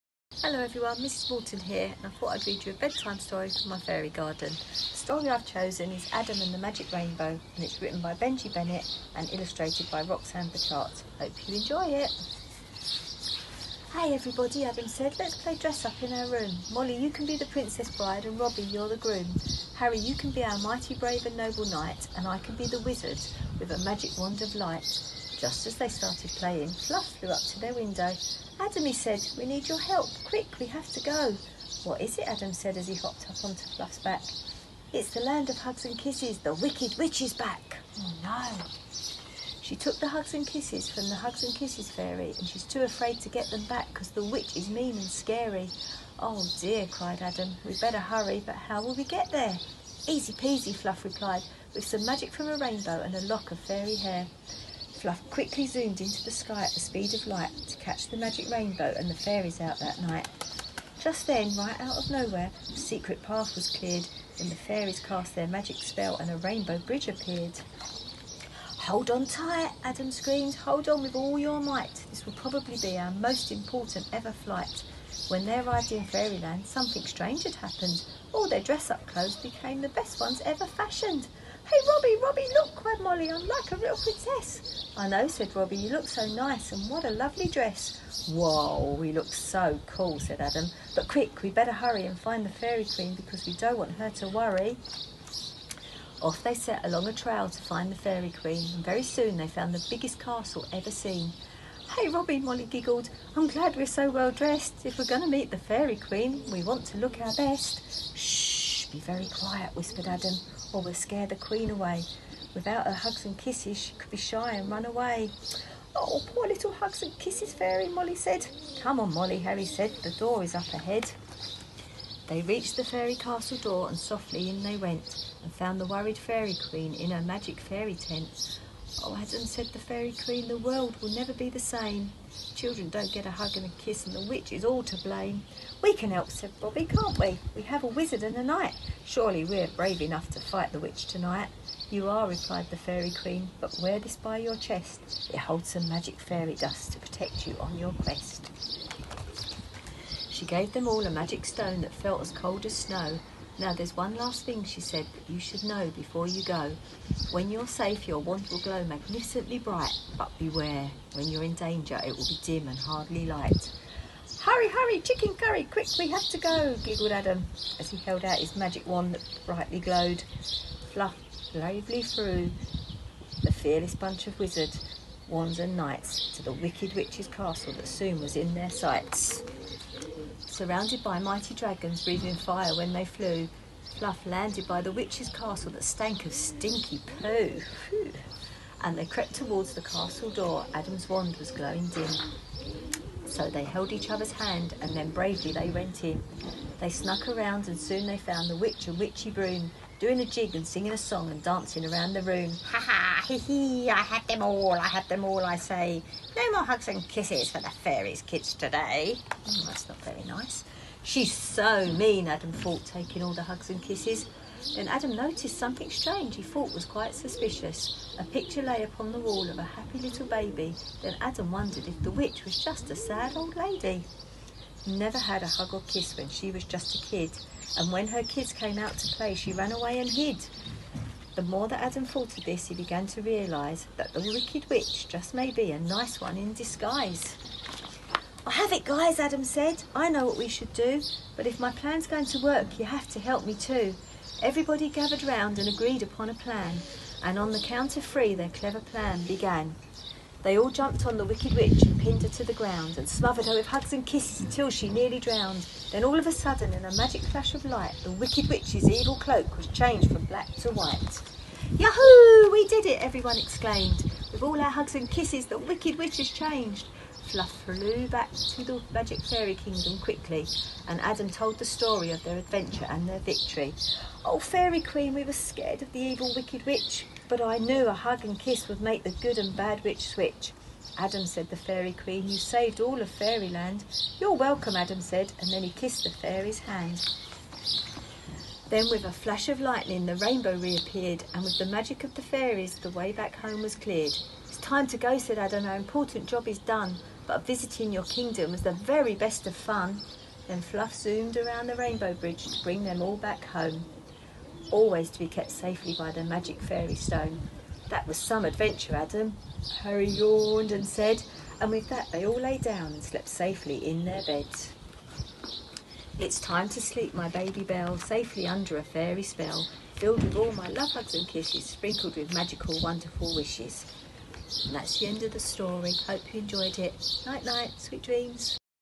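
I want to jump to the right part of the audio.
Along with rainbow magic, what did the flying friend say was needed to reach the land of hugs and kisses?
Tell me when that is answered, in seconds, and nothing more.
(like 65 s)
53 s.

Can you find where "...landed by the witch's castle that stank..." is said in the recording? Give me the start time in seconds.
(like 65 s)
184 s.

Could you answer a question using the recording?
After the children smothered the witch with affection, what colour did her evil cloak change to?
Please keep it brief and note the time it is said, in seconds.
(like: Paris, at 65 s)
White, at 260 s.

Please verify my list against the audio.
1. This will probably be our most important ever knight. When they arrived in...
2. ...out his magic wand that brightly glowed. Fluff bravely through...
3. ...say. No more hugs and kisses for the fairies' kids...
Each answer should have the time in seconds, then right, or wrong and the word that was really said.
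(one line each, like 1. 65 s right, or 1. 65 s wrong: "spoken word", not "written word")
1. 72 s wrong: "flight", not "knight"
2. 168 s right
3. 205 s right.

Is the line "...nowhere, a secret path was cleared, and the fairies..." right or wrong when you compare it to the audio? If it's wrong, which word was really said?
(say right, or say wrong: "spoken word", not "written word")
right.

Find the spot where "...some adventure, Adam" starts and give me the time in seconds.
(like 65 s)
308 s.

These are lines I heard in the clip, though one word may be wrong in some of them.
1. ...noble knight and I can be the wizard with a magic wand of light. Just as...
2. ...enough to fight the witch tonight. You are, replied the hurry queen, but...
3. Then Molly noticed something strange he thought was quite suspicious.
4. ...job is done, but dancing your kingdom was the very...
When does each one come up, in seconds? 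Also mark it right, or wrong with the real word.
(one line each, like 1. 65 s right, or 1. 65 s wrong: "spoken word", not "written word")
1. 21 s right
2. 140 s wrong: "fairy", not "hurry"
3. 214 s wrong: "Adam", not "Molly"
4. 296 s wrong: "visiting", not "dancing".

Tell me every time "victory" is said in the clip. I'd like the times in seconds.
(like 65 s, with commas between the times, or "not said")
273 s.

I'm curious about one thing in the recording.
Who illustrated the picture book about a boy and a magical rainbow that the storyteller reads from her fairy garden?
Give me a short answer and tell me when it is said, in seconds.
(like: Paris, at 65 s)
Roxanne Burchartz, at 10 s.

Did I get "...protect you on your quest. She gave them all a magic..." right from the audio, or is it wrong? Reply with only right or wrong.
right.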